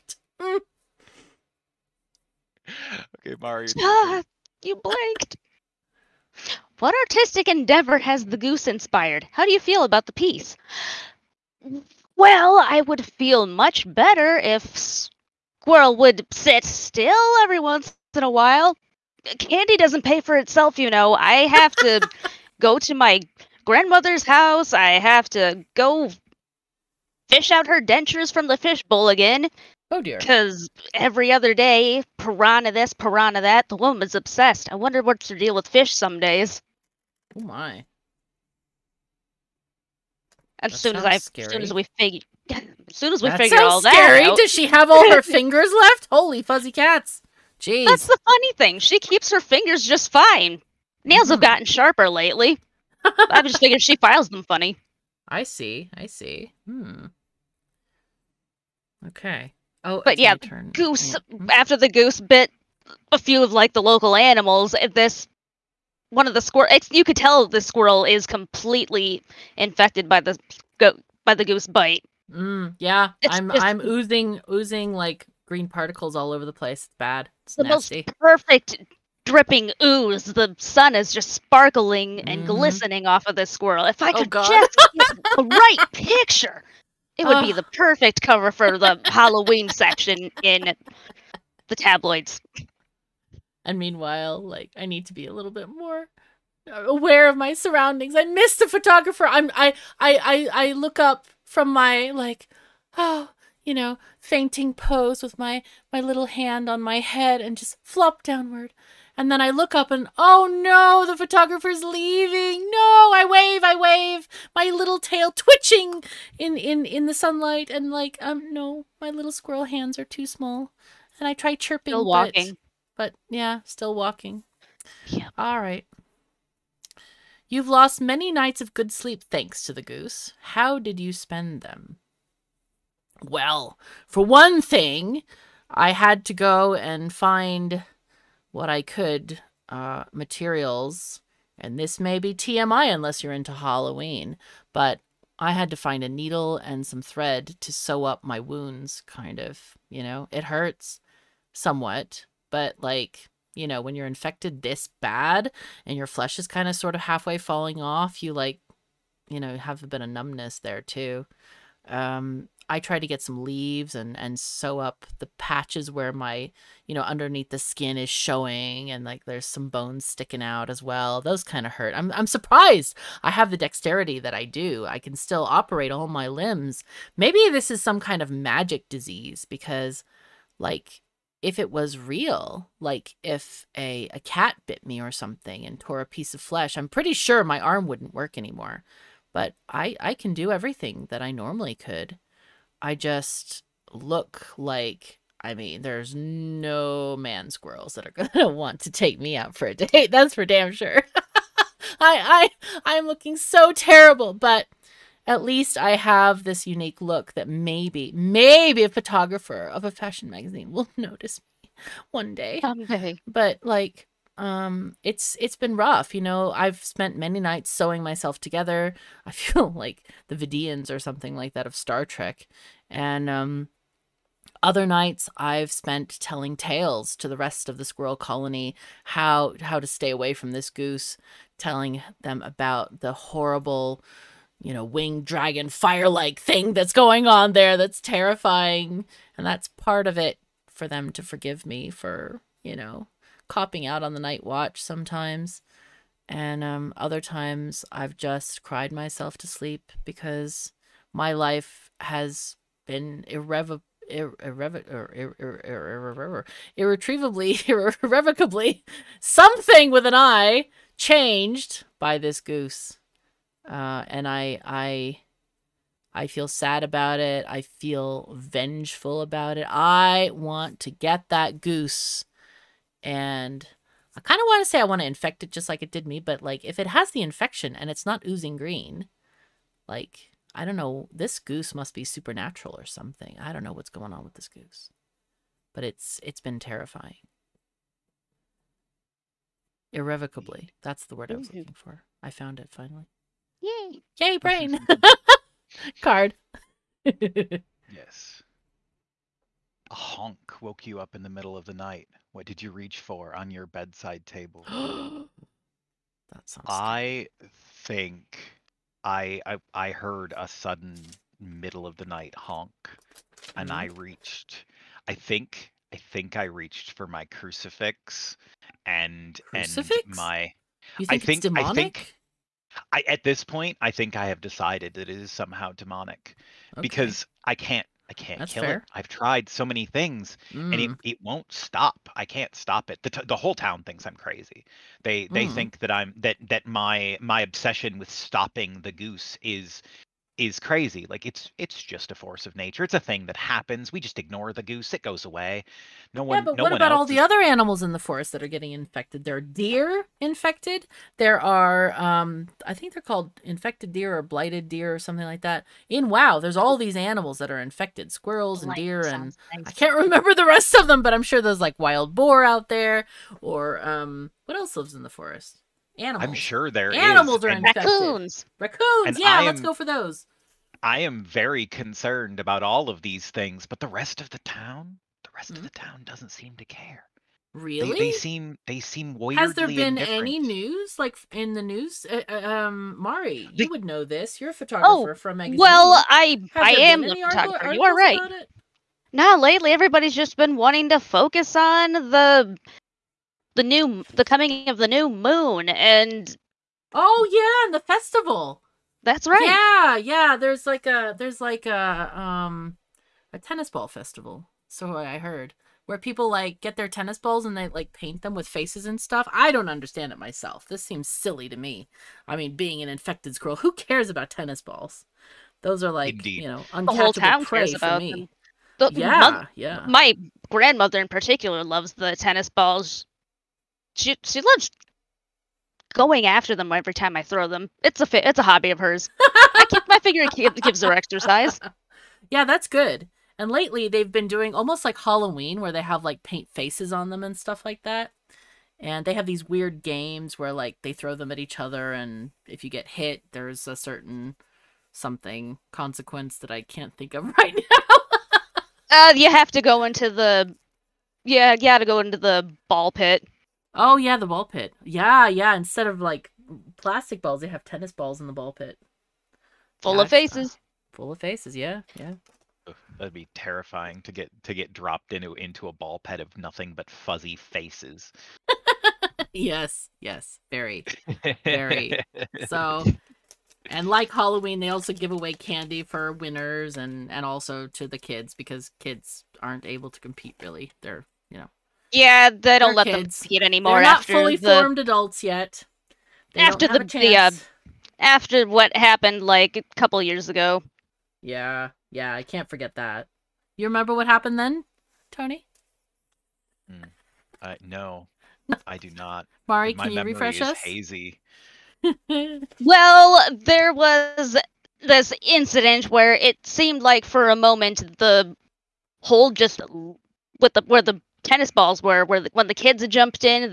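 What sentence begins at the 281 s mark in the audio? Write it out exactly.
This goose must be supernatural or something.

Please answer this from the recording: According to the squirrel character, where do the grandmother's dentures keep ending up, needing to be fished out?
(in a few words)
The fishbowl.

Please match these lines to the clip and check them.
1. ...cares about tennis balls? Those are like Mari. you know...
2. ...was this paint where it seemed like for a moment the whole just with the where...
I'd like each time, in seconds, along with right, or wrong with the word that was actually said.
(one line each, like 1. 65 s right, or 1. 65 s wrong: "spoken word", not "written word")
1. 413 s wrong: "Indeed", not "Mari"
2. 503 s wrong: "incident", not "paint".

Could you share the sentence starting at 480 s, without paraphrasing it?
They're yeah, they don't let kids.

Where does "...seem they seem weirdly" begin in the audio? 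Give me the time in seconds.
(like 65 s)
378 s.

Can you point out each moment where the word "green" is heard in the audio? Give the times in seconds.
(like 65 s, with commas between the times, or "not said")
75 s, 278 s.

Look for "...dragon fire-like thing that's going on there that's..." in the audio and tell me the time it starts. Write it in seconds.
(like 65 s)
235 s.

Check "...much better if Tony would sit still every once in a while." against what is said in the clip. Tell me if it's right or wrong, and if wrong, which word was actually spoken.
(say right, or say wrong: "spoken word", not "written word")
wrong: "Squirrel", not "Tony".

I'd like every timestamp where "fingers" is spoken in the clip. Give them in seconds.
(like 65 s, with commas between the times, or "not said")
45 s, 49 s.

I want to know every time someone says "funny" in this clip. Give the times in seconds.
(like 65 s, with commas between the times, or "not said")
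48 s, 54 s.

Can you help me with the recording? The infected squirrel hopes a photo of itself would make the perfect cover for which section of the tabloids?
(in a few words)
Halloween section.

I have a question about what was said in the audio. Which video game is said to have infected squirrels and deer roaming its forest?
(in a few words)
WoW.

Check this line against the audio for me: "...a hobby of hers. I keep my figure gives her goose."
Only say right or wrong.
wrong.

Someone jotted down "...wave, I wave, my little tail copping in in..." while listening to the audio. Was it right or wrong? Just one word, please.
wrong.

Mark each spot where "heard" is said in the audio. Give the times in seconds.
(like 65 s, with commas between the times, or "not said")
309 s, 405 s.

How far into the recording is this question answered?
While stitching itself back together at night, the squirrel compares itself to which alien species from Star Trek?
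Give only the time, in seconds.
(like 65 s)
220 s.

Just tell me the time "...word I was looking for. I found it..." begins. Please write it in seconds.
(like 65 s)
291 s.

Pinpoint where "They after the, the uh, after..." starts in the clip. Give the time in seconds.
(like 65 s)
486 s.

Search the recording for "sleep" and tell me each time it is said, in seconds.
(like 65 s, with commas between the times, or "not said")
128 s, 249 s.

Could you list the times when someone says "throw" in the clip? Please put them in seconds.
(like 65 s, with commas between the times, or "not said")
427 s, 440 s.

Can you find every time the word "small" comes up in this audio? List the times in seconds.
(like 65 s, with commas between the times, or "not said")
120 s.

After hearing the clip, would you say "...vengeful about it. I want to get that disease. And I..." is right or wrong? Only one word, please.
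wrong.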